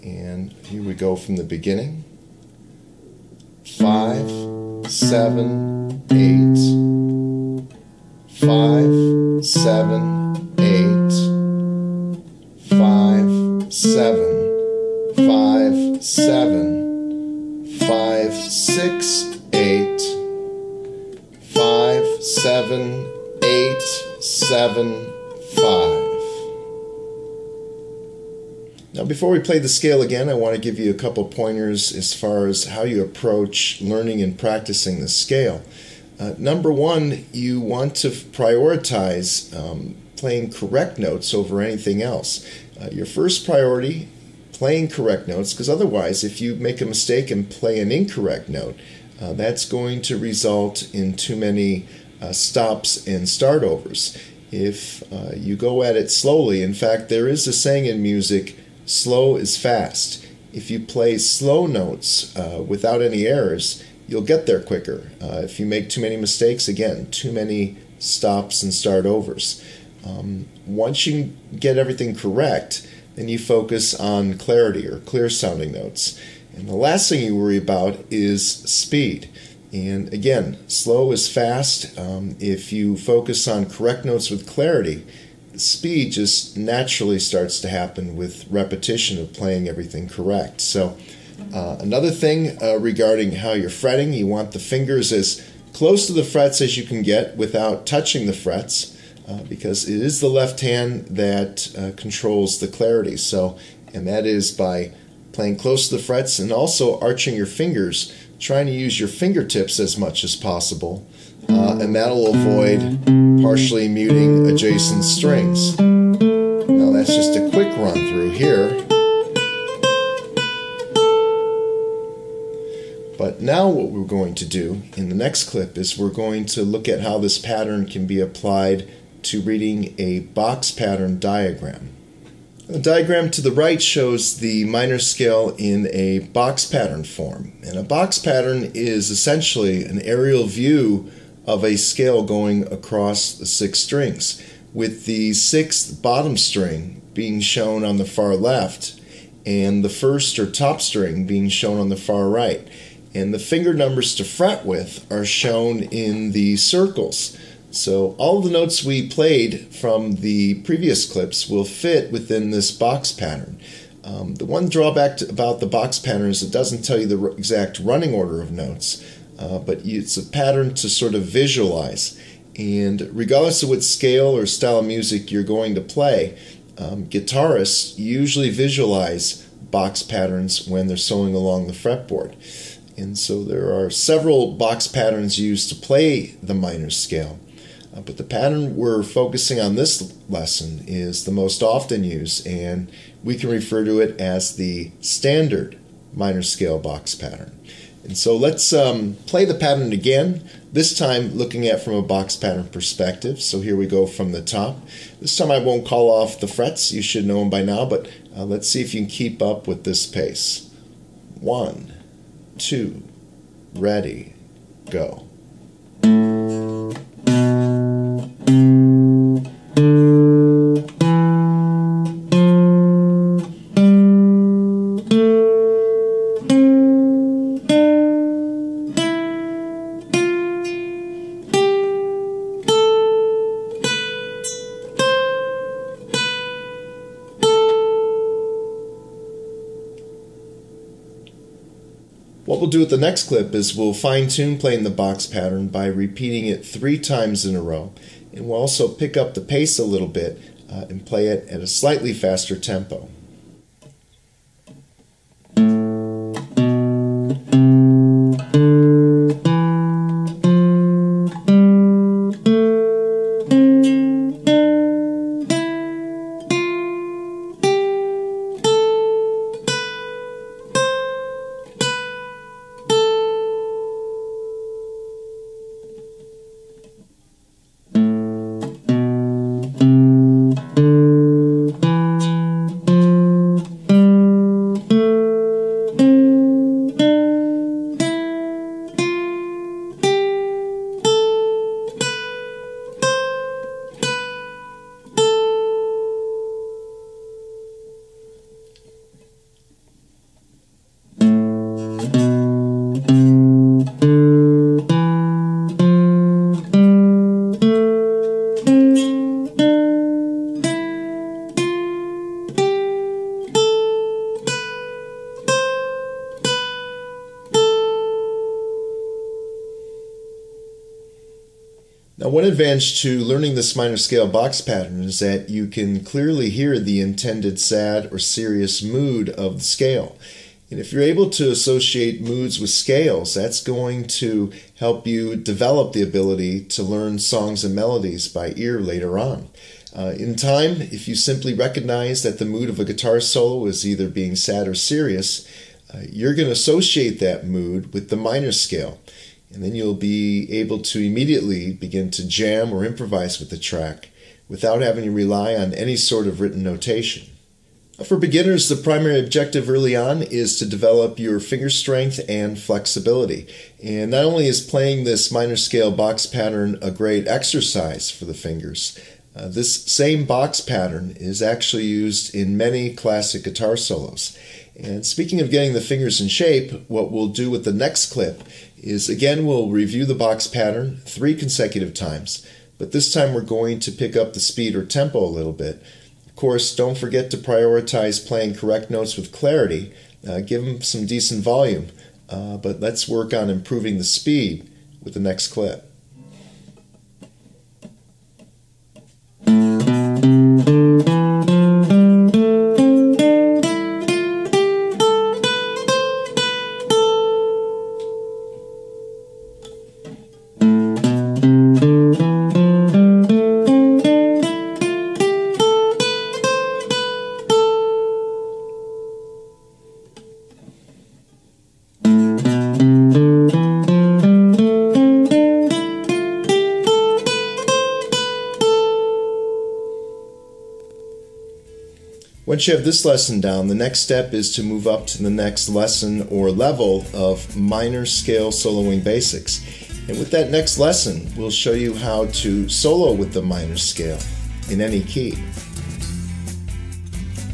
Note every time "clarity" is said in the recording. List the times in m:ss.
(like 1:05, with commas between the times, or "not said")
1:14, 1:24, 1:42, 6:29.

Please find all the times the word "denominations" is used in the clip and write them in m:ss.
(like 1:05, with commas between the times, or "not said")
not said.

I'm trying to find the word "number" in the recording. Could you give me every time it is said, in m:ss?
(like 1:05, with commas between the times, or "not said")
0:36, 2:33.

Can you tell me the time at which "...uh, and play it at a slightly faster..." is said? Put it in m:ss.
4:10.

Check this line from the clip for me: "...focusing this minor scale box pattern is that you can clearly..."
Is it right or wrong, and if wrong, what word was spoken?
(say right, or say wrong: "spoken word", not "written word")
wrong: "learning", not "focusing".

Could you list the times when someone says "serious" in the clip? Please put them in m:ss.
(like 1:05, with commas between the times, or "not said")
5:28, 5:44.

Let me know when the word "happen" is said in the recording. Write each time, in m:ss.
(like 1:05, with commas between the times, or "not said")
1:27.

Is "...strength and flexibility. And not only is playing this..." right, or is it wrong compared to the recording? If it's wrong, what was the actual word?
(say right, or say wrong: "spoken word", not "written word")
right.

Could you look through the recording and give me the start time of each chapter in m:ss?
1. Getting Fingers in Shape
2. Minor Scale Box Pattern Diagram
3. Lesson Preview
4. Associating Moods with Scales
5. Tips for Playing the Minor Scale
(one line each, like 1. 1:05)
1. 5:57
2. 2:12
3. 7:11
4. 5:21
5. 0:28.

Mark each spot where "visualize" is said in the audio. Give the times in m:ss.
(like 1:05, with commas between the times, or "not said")
2:51, 2:58.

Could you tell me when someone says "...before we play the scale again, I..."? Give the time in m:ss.
0:29.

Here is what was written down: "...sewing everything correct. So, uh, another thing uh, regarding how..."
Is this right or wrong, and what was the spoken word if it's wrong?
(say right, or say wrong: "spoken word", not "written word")
wrong: "playing", not "sewing".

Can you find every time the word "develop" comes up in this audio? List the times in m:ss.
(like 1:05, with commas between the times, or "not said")
5:35, 6:00.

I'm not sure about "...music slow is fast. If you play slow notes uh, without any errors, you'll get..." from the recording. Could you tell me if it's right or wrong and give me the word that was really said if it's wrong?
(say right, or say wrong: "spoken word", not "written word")
right.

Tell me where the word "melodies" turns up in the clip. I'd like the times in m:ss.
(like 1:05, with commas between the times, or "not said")
5:37.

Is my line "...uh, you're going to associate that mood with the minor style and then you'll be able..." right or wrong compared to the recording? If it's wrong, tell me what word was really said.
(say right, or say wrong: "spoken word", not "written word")
wrong: "scale", not "style".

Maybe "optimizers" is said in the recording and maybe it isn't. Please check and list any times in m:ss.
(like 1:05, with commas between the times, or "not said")
not said.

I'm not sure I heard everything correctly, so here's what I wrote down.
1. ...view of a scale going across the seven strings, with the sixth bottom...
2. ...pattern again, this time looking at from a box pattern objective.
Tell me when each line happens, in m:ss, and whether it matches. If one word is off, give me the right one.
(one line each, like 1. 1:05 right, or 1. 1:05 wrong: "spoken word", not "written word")
1. 2:20 wrong: "six", not "seven"
2. 3:19 wrong: "perspective", not "objective".